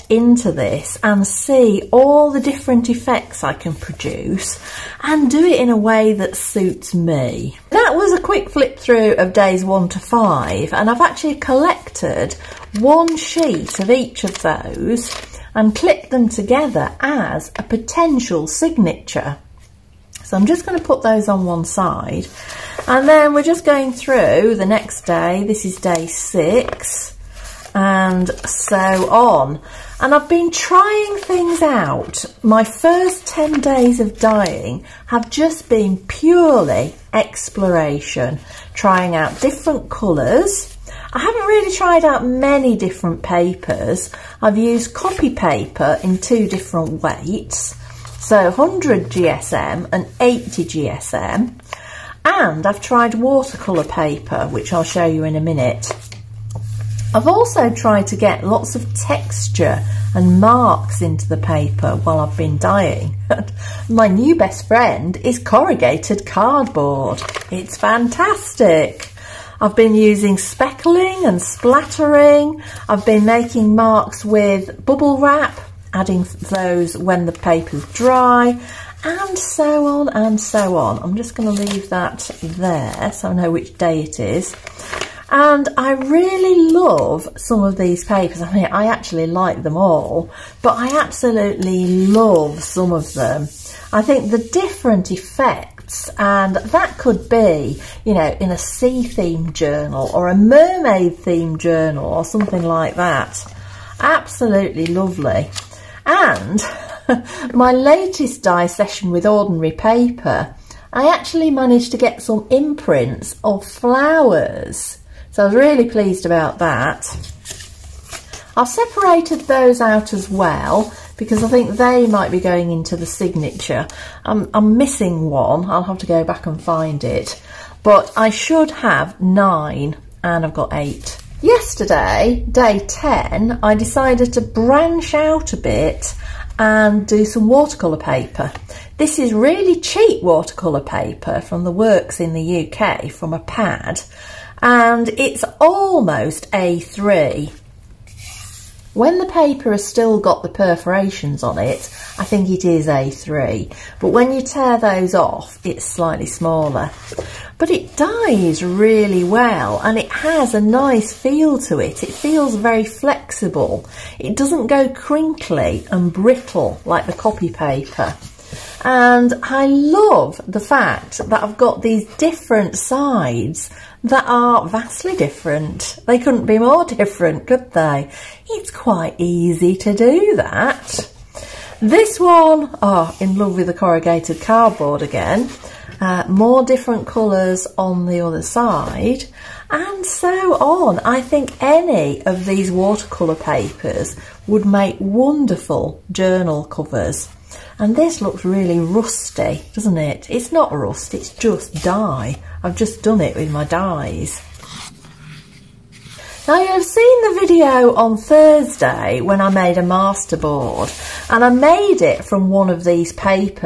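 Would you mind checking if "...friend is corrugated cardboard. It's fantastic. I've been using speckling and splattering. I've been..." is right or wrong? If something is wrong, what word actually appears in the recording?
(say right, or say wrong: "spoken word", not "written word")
right.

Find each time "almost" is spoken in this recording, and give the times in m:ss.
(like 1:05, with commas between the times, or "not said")
2:25.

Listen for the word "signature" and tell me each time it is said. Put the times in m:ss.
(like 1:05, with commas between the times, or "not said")
0:18, 2:03.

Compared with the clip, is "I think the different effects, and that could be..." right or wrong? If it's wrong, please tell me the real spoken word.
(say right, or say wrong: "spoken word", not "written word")
right.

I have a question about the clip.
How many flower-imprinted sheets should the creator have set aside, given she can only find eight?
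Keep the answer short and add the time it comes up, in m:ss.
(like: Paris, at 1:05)
9, at 2:09.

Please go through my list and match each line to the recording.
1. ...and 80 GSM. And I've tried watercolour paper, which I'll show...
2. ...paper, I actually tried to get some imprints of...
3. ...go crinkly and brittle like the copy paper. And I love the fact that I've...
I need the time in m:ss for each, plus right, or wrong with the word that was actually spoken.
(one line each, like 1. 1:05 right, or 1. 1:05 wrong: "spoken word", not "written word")
1. 0:49 right
2. 1:49 wrong: "managed", not "tried"
3. 2:44 right.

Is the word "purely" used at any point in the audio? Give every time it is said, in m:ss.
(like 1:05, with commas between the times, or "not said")
0:35.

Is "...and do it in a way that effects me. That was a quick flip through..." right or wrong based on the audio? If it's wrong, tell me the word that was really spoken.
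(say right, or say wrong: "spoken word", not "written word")
wrong: "suits", not "effects".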